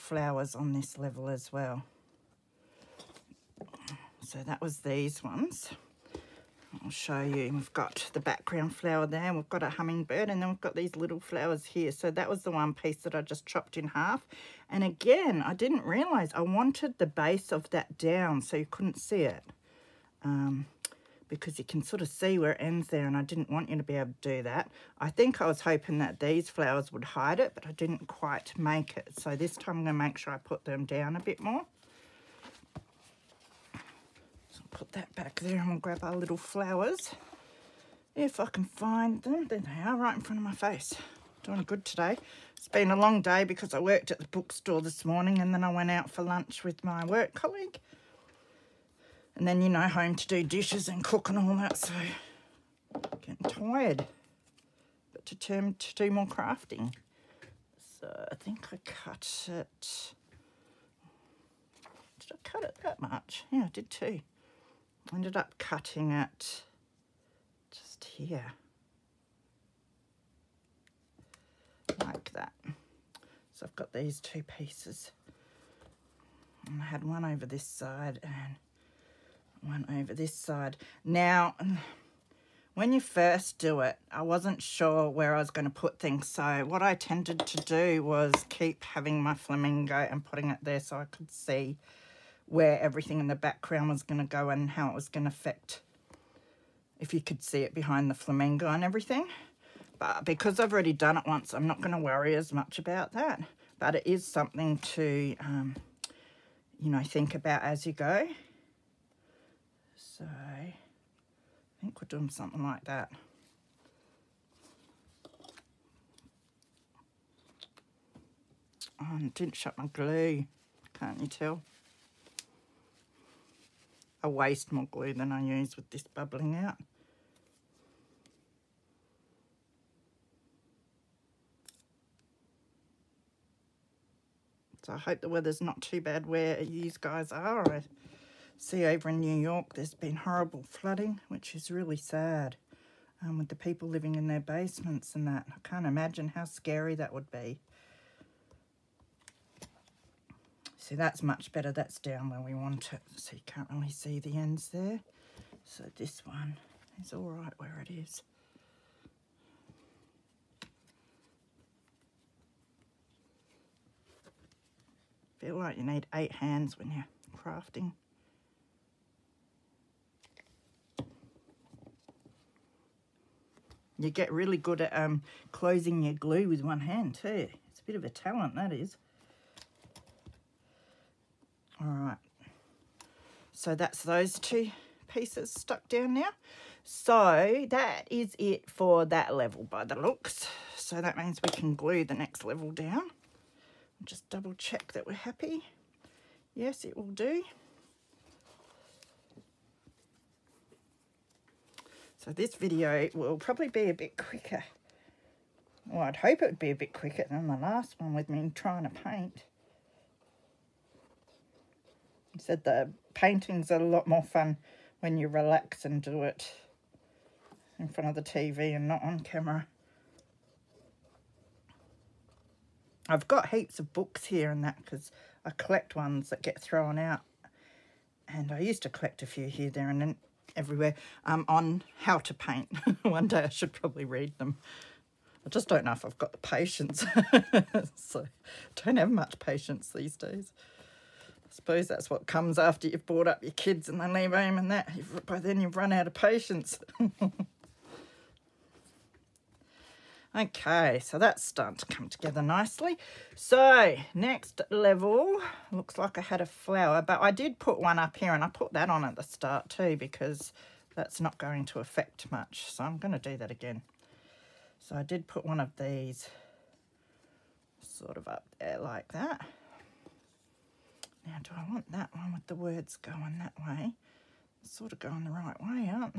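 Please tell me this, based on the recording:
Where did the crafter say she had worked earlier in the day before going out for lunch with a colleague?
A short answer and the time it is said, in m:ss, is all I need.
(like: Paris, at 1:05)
the bookstore, at 0:44.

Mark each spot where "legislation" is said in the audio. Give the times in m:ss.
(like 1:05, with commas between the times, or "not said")
not said.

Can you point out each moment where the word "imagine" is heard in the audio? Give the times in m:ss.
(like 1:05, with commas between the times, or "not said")
2:25.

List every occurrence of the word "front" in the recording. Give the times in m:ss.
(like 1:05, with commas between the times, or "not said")
0:40, 3:37.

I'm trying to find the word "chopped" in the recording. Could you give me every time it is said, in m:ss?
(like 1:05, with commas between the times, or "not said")
0:13.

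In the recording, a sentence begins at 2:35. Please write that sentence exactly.
So this one is all right where it is.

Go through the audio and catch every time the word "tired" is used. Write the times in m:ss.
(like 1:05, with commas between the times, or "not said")
0:53.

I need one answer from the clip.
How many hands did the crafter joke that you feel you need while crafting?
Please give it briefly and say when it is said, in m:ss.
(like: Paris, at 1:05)
8, at 2:46.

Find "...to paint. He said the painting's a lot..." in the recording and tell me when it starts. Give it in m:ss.
3:28.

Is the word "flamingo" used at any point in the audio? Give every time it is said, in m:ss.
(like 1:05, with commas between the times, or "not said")
1:29, 1:38.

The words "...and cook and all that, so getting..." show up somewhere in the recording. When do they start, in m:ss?
0:50.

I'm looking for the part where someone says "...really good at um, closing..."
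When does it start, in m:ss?
2:54.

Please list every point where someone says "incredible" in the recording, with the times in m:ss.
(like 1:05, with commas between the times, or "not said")
not said.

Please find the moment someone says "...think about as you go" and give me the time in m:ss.
1:47.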